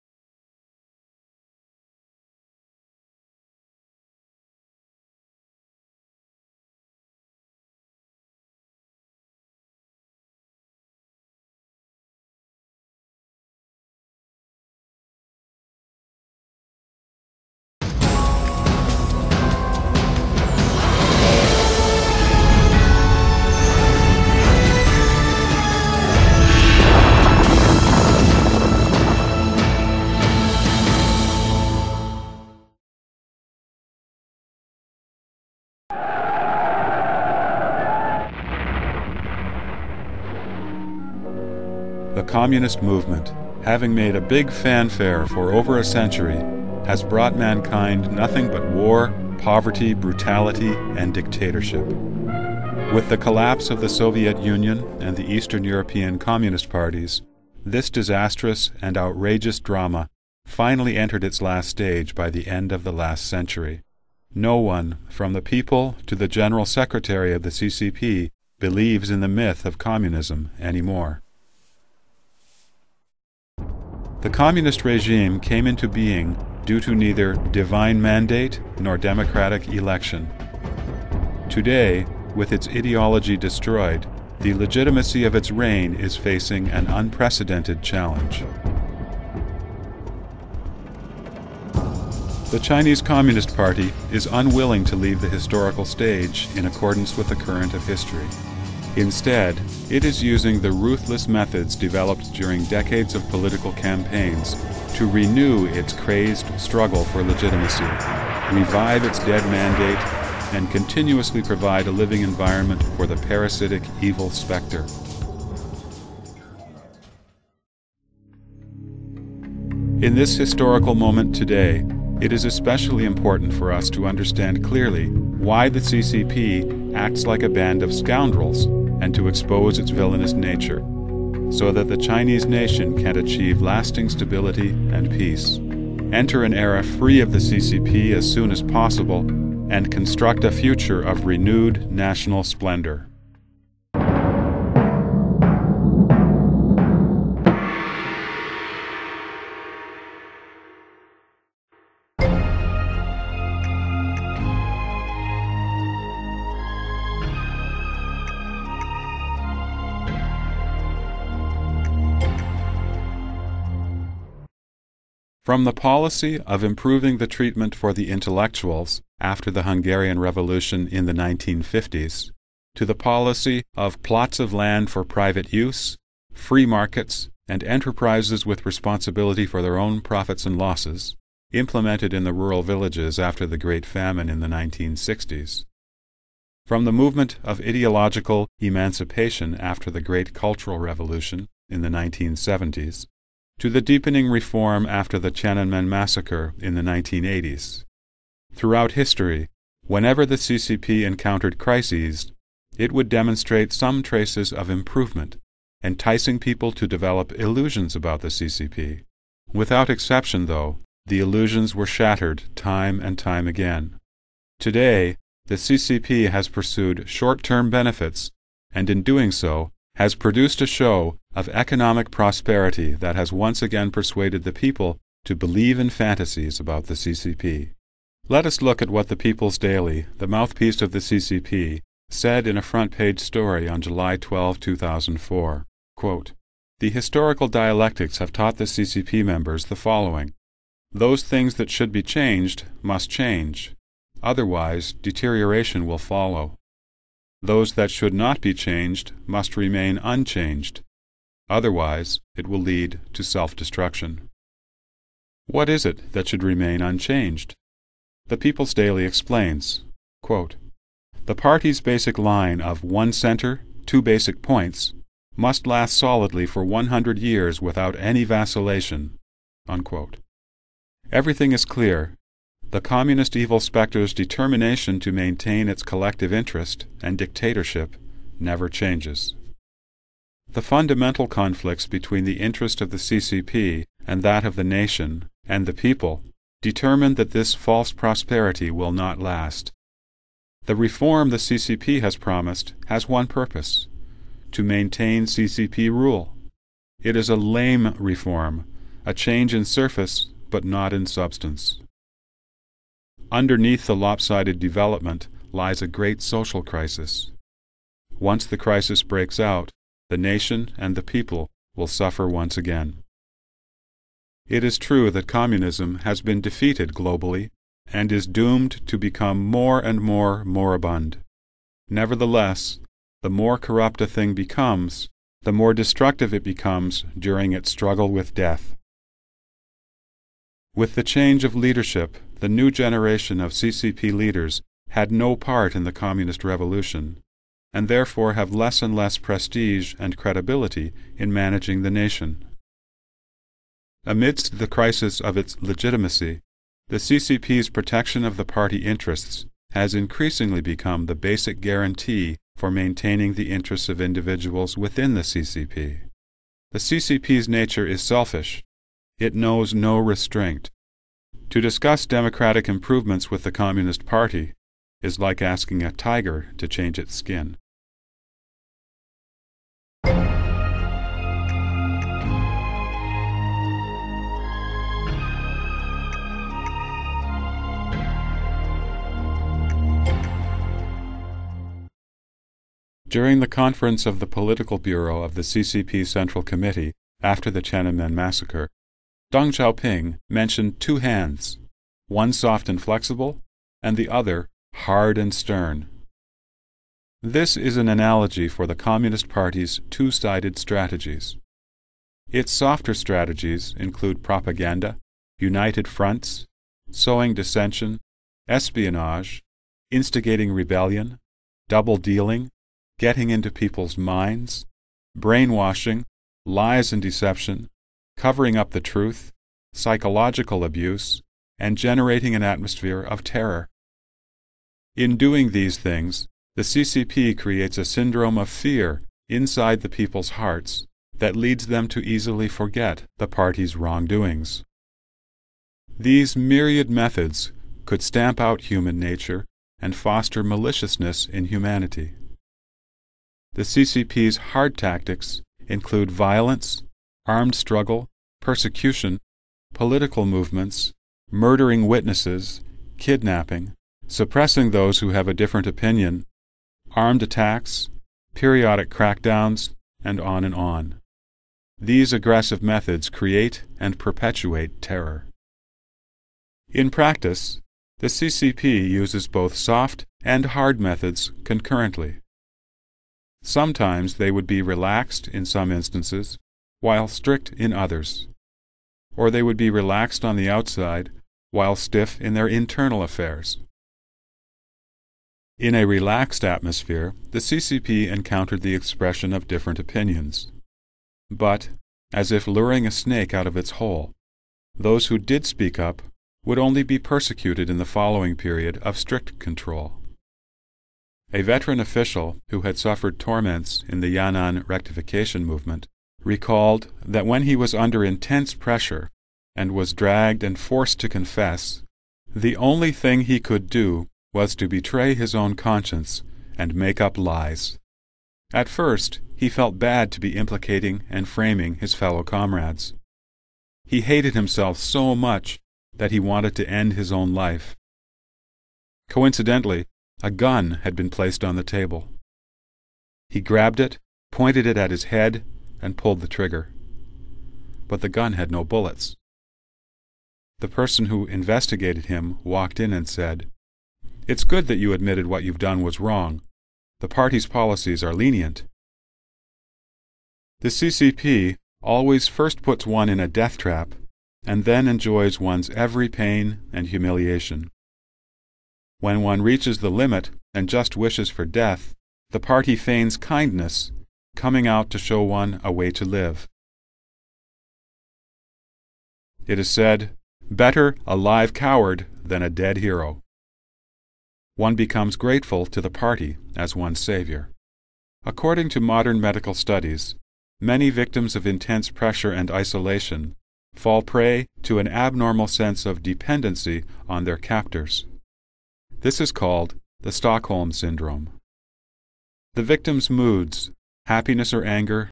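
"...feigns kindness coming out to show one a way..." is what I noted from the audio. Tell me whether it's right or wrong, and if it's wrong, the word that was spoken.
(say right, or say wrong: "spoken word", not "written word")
right.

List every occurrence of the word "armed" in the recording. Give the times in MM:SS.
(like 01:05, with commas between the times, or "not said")
07:27, 07:36.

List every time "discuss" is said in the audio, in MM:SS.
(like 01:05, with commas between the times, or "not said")
06:01.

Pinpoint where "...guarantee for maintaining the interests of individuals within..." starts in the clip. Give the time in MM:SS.
05:51.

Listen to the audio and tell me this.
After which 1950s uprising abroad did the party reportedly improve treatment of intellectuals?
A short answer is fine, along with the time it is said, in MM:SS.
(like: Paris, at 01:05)
Hungarian Revolution, at 02:49.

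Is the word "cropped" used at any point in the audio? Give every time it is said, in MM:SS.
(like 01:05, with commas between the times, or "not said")
not said.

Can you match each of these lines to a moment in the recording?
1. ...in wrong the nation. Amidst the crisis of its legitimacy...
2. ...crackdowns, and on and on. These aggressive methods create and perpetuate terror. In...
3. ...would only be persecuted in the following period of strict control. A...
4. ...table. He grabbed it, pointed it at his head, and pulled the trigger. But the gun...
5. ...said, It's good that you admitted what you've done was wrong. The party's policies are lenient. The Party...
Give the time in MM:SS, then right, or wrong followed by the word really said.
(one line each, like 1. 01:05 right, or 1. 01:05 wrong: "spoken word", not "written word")
1. 05:41 wrong: "managing", not "wrong"
2. 07:38 right
3. 08:16 right
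4. 08:51 right
5. 09:03 wrong: "CCP", not "Party".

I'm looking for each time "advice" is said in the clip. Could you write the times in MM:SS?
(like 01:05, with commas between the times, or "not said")
not said.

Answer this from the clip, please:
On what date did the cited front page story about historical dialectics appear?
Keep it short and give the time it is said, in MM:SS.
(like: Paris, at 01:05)
July 12, 2004, at 03:53.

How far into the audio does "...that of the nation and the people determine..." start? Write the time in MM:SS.
04:44.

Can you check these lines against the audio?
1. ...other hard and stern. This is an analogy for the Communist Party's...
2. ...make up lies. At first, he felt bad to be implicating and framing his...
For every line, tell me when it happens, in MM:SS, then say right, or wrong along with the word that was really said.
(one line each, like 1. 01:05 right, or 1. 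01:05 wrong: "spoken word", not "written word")
1. 06:34 right
2. 08:36 right.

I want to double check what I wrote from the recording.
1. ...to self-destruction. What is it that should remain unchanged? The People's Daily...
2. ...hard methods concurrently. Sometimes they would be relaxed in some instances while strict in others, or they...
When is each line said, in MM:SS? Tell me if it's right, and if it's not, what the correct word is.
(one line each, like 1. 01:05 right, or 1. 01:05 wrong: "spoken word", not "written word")
1. 04:13 right
2. 07:50 right.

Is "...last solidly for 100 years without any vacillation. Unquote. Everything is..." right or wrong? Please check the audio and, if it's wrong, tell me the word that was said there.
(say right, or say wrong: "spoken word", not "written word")
right.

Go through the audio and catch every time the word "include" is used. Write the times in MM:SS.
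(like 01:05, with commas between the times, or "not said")
06:43, 07:25.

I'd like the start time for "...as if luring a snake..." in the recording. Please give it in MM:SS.
08:12.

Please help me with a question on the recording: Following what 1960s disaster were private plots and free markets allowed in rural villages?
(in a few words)
Great Famine.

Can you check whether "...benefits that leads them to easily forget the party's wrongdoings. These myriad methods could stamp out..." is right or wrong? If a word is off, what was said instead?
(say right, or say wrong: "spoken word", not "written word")
wrong: "hearts", not "benefits".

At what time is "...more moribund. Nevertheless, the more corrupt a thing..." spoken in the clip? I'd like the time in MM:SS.
05:20.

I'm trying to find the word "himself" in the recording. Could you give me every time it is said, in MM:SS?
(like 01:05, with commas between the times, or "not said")
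08:44.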